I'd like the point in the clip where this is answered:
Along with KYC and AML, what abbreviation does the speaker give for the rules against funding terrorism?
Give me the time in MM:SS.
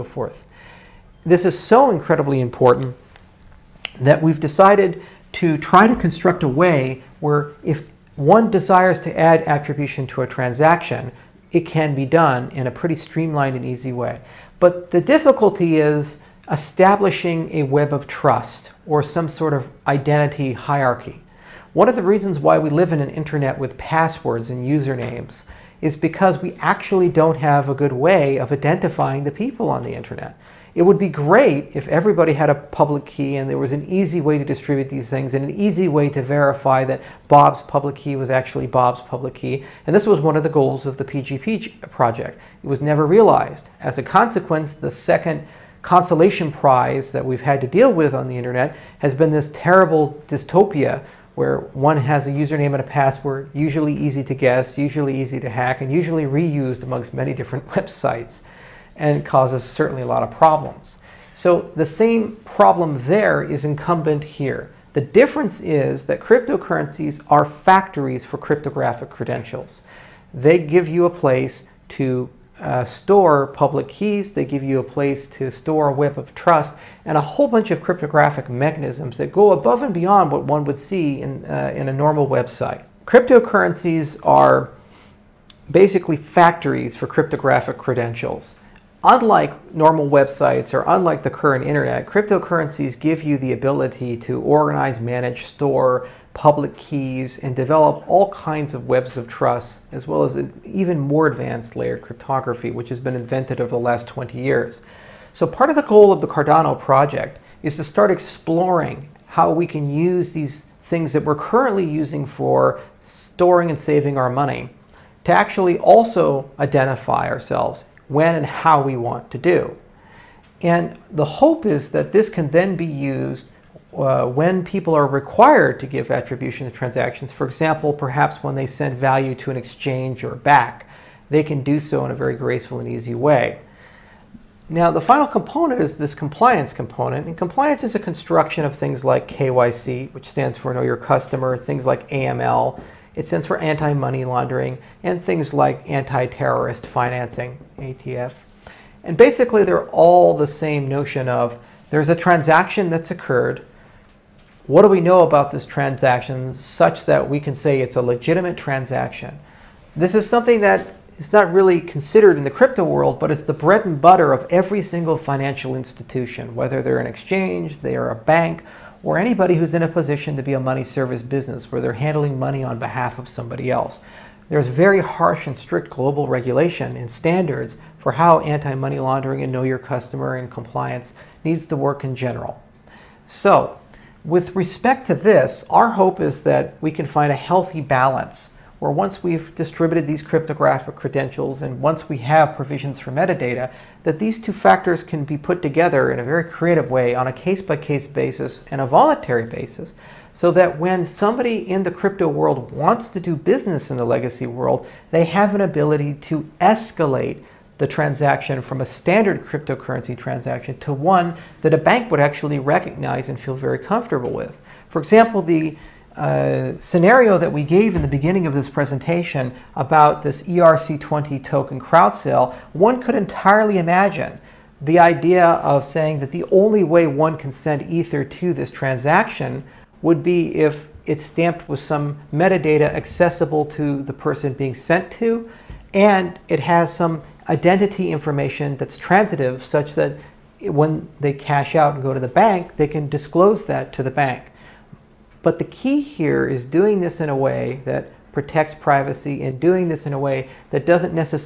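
02:27.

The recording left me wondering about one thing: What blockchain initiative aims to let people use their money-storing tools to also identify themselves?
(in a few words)
Cardano.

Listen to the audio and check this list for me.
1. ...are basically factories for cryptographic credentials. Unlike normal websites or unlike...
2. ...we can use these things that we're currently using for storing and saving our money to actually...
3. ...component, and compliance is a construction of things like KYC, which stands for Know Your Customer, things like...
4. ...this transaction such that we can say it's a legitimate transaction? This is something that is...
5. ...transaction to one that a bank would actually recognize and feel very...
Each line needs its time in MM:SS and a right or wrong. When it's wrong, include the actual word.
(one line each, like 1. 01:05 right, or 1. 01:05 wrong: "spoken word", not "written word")
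1. 01:24 right
2. 01:49 right
3. 02:16 right
4. 02:35 right
5. 03:30 right.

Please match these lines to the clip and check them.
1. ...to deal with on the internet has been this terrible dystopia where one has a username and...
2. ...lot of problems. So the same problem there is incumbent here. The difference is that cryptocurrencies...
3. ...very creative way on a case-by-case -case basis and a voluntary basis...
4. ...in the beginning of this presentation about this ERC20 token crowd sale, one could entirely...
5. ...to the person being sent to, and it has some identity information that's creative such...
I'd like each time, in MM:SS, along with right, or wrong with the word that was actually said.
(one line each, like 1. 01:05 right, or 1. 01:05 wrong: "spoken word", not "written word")
1. 00:47 right
2. 01:00 right
3. 03:16 right
4. 03:37 right
5. 03:53 wrong: "transitive", not "creative".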